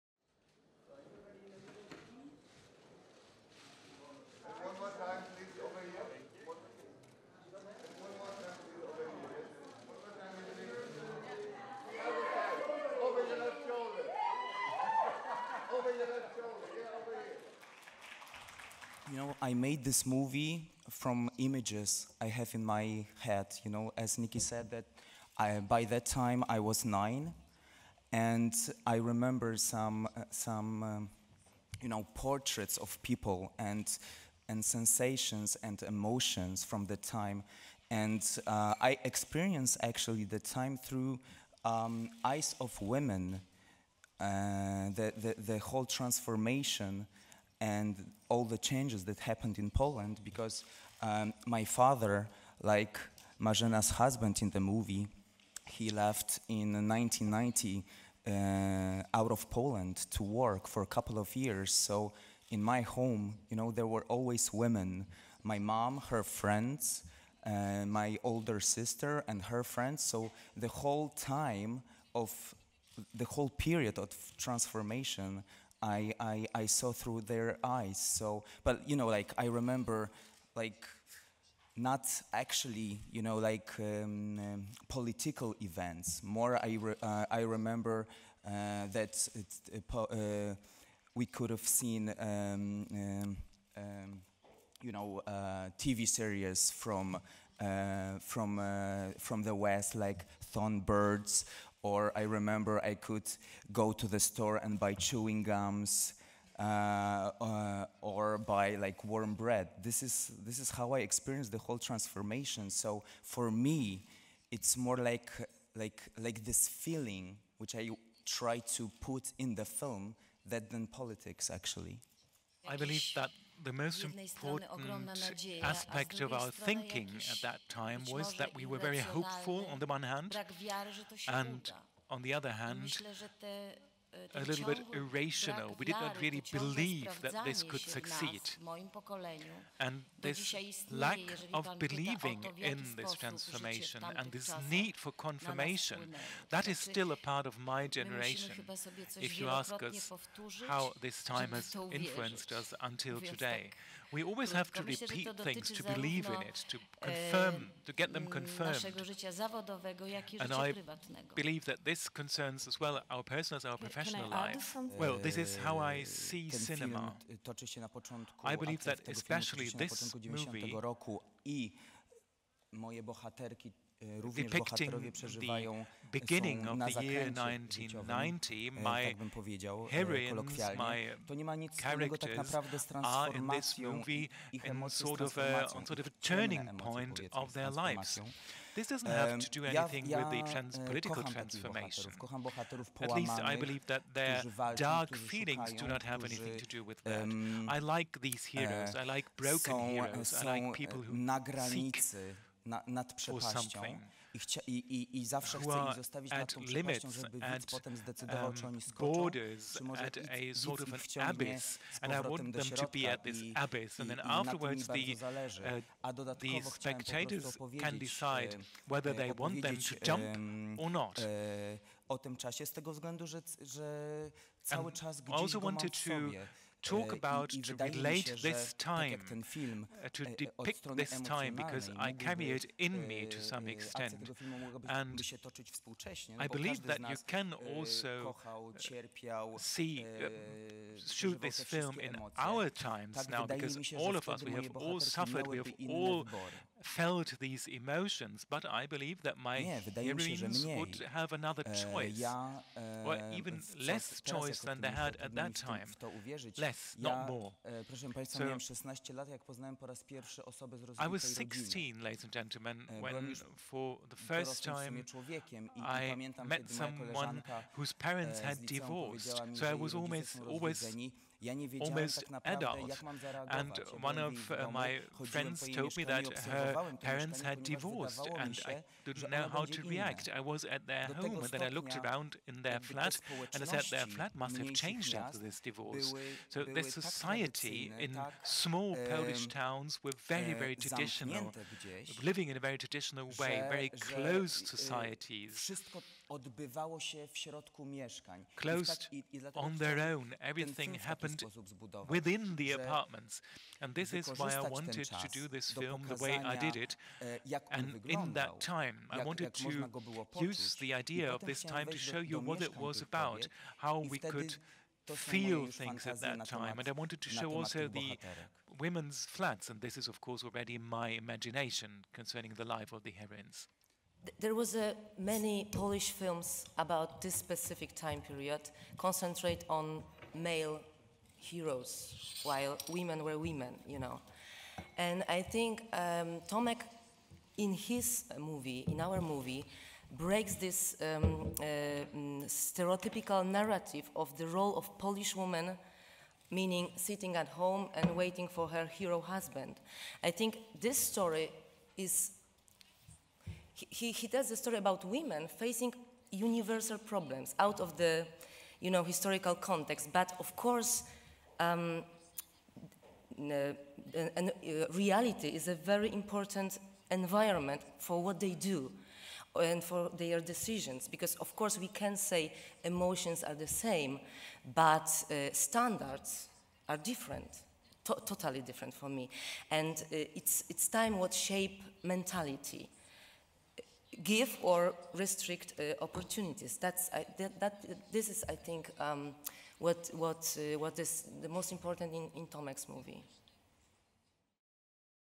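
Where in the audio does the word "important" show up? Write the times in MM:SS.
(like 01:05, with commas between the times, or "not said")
02:04, 06:06, 06:31.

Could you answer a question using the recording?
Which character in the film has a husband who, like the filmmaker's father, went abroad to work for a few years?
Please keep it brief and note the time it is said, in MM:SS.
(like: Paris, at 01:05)
Marzena, at 00:53.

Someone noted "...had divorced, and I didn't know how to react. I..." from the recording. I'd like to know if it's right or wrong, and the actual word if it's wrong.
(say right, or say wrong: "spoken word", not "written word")
right.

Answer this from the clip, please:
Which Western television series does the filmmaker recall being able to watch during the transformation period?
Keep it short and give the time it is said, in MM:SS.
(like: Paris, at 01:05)
Thorn Birds, at 01:40.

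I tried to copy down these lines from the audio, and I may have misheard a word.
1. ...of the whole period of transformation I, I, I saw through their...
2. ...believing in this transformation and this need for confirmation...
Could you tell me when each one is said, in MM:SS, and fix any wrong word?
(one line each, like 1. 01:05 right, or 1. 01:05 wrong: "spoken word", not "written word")
1. 01:12 right
2. 02:21 right.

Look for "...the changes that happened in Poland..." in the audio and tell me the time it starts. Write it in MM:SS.
00:48.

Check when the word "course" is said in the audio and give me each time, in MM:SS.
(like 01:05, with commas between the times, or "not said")
05:20, 06:00, 06:11.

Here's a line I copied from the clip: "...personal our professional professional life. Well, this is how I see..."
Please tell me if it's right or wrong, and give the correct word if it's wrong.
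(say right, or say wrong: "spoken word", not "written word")
right.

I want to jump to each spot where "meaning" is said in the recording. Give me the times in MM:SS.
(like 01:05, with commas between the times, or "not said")
05:46.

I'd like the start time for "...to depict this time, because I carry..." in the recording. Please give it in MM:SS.
03:50.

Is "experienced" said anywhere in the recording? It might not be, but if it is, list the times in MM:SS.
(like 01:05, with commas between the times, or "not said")
00:39, 01:50.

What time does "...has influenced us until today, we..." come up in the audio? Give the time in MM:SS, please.
02:31.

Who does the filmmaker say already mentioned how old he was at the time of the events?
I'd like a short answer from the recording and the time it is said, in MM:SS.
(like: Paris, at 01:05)
Nikki, at 00:24.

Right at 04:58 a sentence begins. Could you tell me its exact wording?
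Closed I tak, i, i on their own.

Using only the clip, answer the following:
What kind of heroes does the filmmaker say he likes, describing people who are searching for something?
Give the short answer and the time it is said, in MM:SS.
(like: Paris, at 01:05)
Broken heroes, at 03:19.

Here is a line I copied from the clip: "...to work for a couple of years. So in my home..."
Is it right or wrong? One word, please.
right.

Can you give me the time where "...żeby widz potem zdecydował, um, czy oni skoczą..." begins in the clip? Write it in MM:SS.
03:27.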